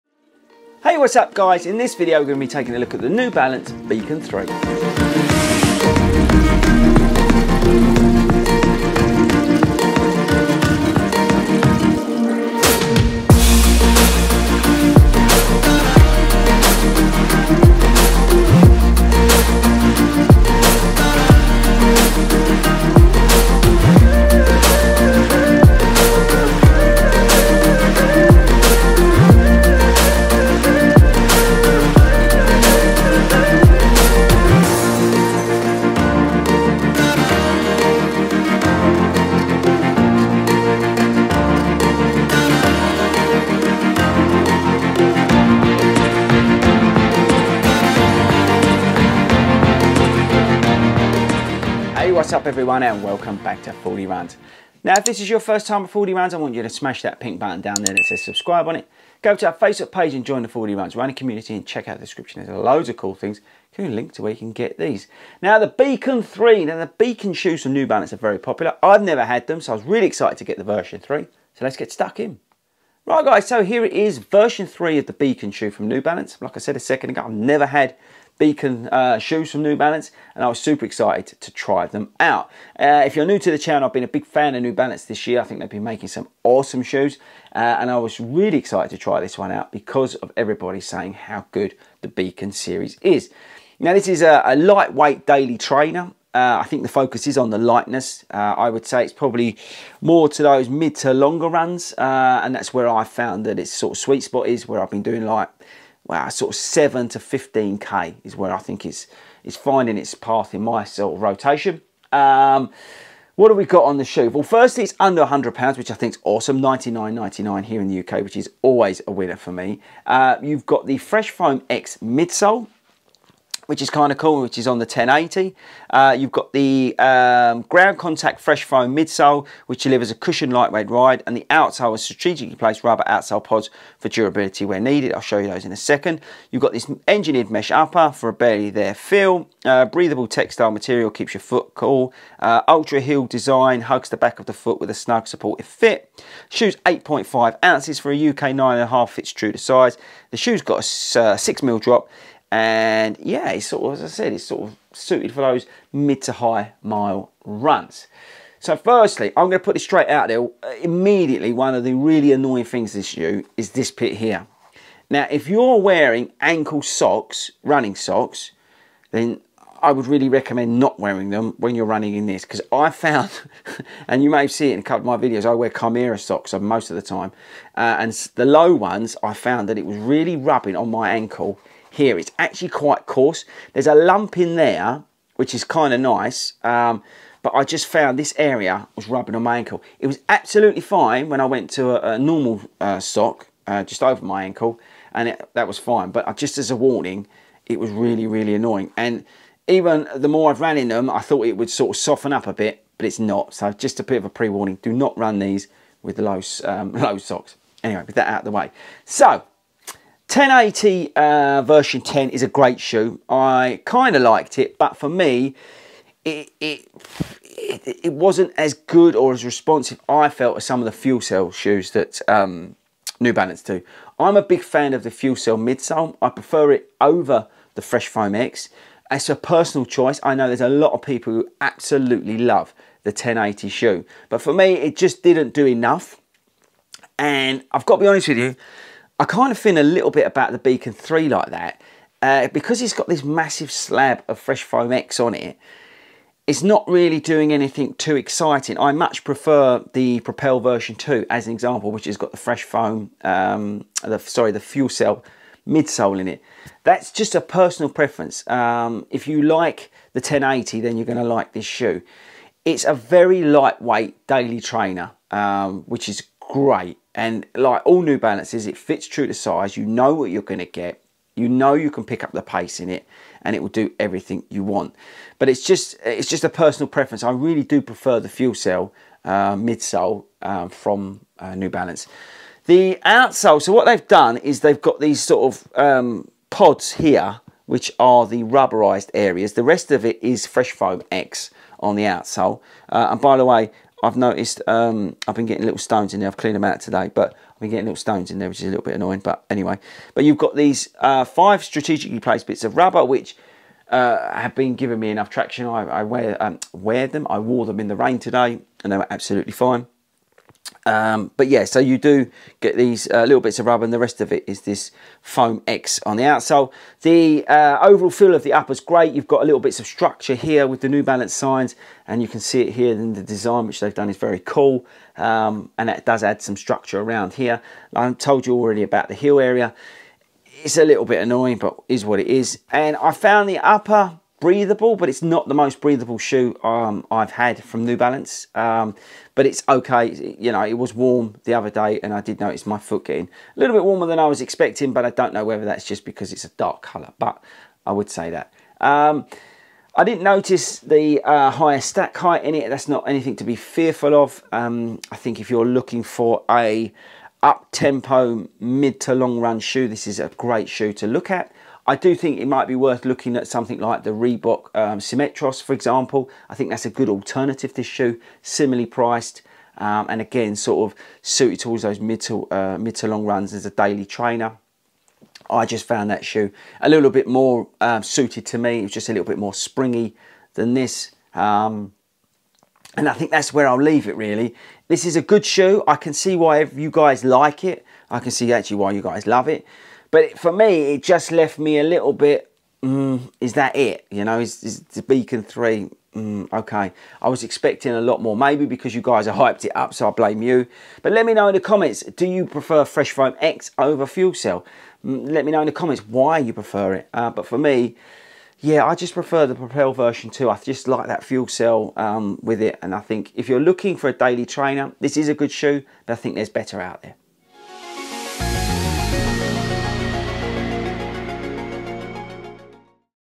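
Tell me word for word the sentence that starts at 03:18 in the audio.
And even the more I've ran in them, I thought it would sort of soften up a bit, but it's not.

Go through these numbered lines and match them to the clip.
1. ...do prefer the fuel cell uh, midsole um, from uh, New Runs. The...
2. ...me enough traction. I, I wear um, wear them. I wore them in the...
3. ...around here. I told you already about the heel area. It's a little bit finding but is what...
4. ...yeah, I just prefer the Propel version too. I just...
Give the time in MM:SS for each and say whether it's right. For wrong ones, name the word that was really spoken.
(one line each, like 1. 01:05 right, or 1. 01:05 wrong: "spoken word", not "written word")
1. 04:37 wrong: "Balance", not "Runs"
2. 05:04 right
3. 05:27 wrong: "annoying", not "finding"
4. 06:48 right.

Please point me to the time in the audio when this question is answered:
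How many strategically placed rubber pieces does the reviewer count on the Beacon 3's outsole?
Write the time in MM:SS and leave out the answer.
05:01.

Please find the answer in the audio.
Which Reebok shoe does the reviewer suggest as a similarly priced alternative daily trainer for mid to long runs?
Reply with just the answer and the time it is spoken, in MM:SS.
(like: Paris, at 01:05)
Symmetros, at 06:04.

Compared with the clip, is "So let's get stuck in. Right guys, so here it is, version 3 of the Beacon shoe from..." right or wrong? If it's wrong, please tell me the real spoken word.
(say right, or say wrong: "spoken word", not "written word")
right.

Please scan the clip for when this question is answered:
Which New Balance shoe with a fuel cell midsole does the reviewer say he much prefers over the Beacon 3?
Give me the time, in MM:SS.
04:10.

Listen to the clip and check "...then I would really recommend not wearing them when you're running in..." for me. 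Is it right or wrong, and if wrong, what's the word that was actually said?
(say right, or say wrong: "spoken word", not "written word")
right.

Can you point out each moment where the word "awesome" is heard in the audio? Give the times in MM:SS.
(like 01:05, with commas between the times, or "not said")
01:26, 01:56.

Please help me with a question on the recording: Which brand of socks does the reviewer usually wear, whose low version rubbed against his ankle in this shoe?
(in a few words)
Kymira.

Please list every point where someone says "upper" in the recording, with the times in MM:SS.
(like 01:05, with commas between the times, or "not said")
02:17, 05:18, 05:33.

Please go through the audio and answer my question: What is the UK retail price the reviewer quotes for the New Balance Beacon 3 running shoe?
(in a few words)
£99.99.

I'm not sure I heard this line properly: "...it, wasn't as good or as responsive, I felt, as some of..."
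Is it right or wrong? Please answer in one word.
right.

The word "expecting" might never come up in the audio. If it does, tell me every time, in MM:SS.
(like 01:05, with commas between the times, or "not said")
05:44, 06:37.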